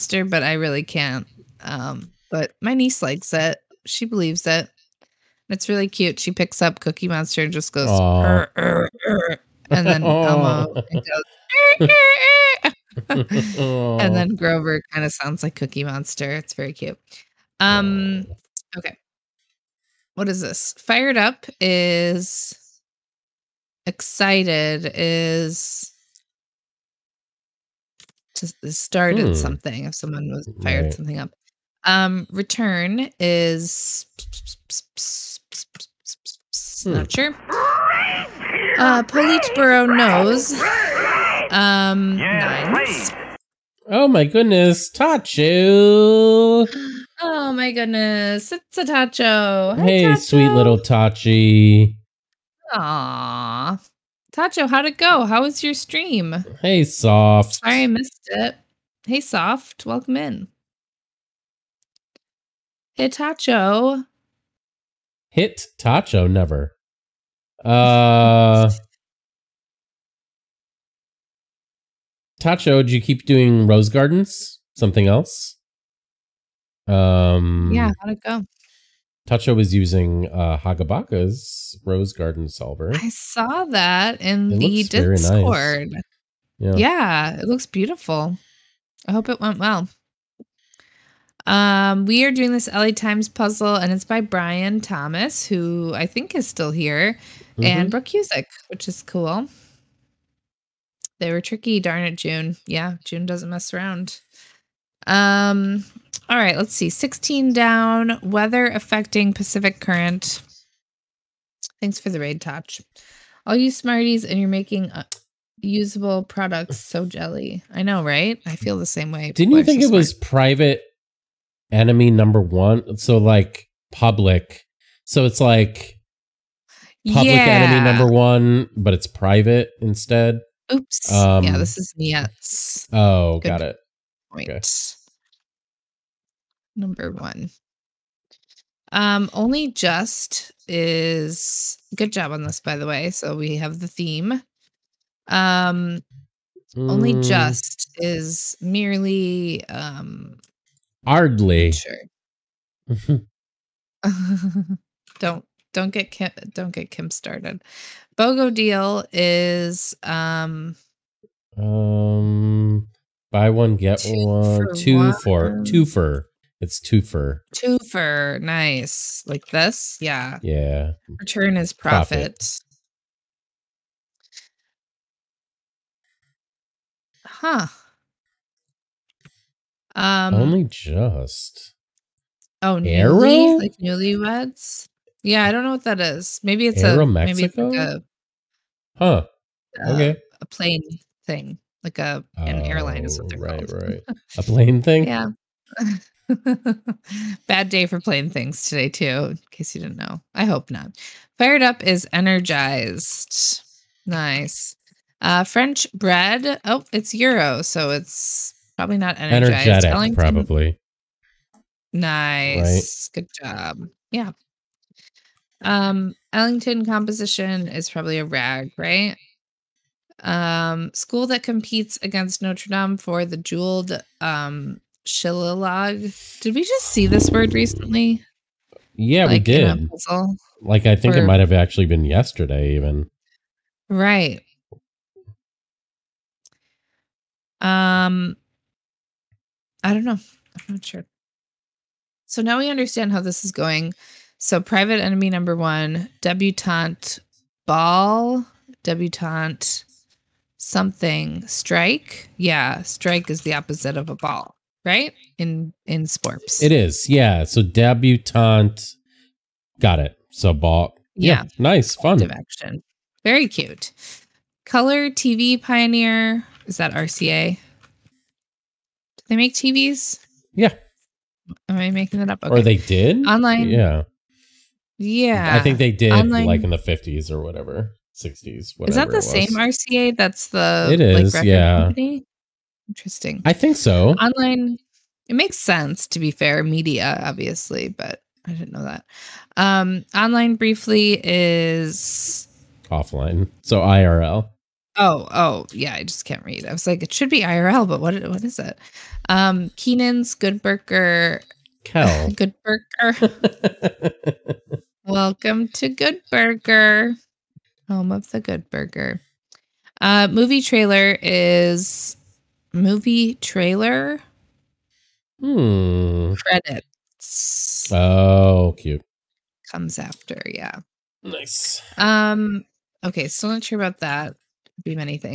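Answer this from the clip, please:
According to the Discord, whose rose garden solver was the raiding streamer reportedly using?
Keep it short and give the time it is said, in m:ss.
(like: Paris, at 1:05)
Hagabaka, at 1:20.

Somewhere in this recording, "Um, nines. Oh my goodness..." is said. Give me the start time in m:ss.
0:41.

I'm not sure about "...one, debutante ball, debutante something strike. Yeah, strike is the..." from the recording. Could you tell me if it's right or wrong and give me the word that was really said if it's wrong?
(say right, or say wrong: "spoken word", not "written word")
right.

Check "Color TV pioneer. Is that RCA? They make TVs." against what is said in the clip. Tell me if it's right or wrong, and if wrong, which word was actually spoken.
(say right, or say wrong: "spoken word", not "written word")
right.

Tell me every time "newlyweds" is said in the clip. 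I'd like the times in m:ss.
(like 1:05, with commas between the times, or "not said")
3:03.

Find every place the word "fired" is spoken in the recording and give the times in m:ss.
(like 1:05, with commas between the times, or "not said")
0:20, 0:30, 3:21.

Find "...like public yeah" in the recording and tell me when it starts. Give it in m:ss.
2:05.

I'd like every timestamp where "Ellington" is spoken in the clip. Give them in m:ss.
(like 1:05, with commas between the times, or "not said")
3:29, 3:36.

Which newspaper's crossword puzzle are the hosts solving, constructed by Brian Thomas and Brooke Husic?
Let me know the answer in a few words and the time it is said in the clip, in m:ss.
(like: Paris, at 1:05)
LA Times, at 1:32.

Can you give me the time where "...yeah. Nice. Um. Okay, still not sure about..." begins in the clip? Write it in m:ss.
5:20.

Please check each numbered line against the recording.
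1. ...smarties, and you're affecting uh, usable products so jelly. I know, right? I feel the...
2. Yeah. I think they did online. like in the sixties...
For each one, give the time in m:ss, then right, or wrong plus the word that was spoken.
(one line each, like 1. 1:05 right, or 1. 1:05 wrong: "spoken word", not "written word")
1. 1:53 wrong: "making", not "affecting"
2. 4:34 wrong: "fifties", not "sixties".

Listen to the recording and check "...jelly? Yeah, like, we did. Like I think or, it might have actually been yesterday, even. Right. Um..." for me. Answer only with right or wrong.
wrong.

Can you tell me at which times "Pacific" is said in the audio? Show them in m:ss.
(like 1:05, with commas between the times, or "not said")
1:49.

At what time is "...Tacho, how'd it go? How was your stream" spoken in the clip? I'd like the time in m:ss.
0:54.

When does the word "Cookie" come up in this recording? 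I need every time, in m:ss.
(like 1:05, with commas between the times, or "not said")
0:06, 0:15.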